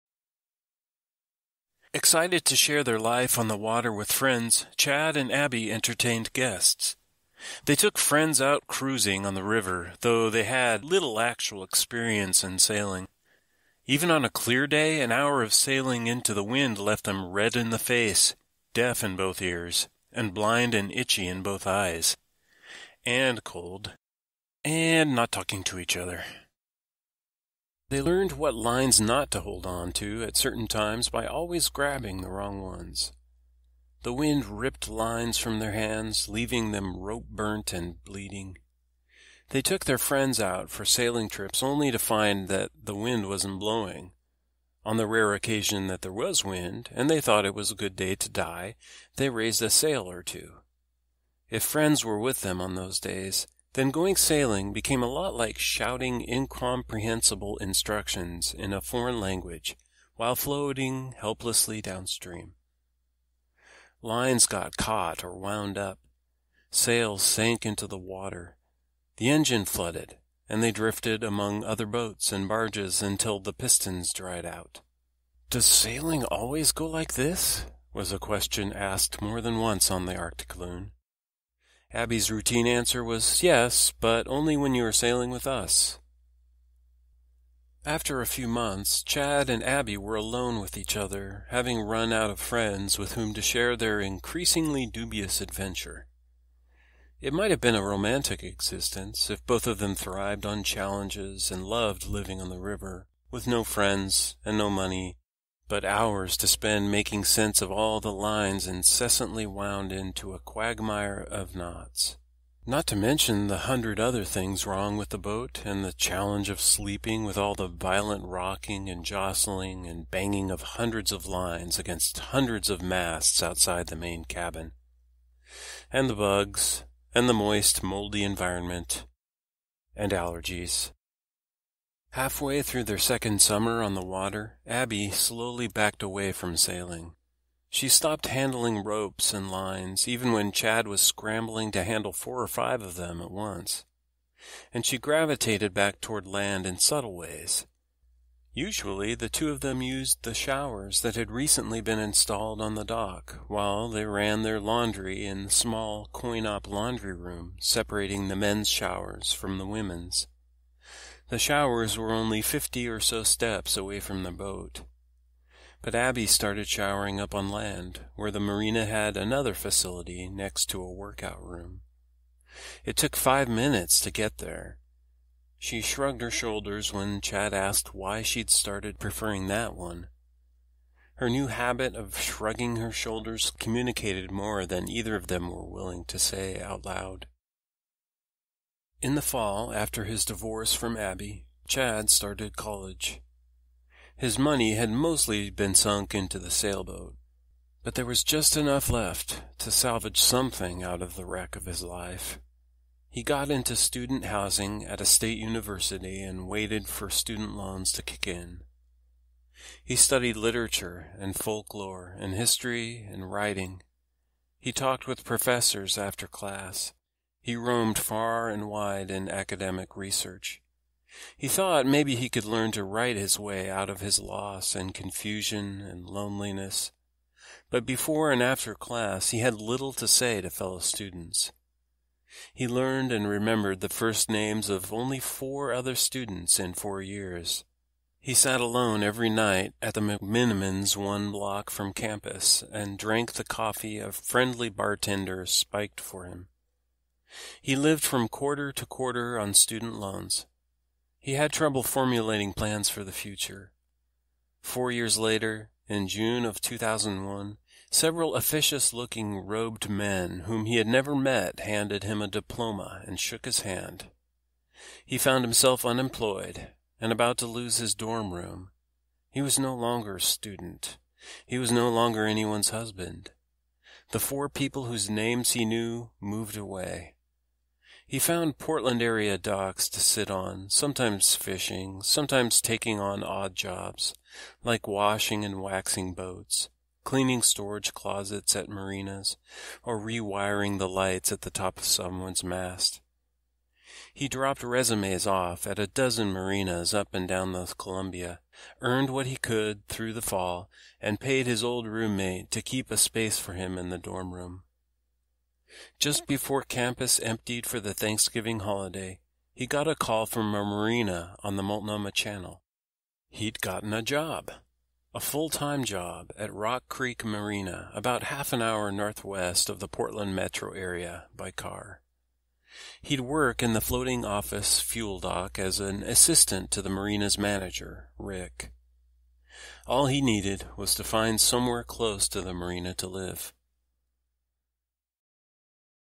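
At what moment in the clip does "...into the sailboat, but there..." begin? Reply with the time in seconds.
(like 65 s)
196 s.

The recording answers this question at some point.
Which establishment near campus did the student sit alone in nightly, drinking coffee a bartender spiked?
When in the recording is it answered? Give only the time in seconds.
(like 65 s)
240 s.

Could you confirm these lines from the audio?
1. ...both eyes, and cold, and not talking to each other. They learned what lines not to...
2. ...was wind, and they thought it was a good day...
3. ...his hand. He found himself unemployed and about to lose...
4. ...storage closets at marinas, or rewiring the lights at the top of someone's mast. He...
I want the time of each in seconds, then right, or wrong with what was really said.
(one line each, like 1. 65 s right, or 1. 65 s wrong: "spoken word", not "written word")
1. 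21 s right
2. 46 s right
3. 263 s right
4. 287 s right.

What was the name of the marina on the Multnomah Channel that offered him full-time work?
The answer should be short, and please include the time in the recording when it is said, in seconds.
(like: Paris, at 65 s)
Rock Creek Marina, at 316 s.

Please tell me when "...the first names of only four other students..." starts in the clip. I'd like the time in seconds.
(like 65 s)
233 s.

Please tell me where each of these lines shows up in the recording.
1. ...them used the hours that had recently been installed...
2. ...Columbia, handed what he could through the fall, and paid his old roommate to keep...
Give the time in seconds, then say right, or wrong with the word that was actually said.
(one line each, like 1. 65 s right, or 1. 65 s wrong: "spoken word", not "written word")
1. 149 s wrong: "showers", not "hours"
2. 297 s wrong: "earned", not "handed".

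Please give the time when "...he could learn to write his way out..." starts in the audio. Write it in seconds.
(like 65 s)
222 s.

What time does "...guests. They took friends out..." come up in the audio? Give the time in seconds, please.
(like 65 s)
6 s.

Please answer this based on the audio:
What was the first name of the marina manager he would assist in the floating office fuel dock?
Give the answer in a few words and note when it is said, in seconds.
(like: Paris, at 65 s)
Rick, at 328 s.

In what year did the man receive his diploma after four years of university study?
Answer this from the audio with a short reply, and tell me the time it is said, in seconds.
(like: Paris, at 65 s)
2001, at 256 s.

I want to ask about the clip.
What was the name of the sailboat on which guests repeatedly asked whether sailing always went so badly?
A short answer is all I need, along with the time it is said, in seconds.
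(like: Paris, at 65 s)
Arctic Loon, at 80 s.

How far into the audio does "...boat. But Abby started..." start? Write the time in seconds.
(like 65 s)
164 s.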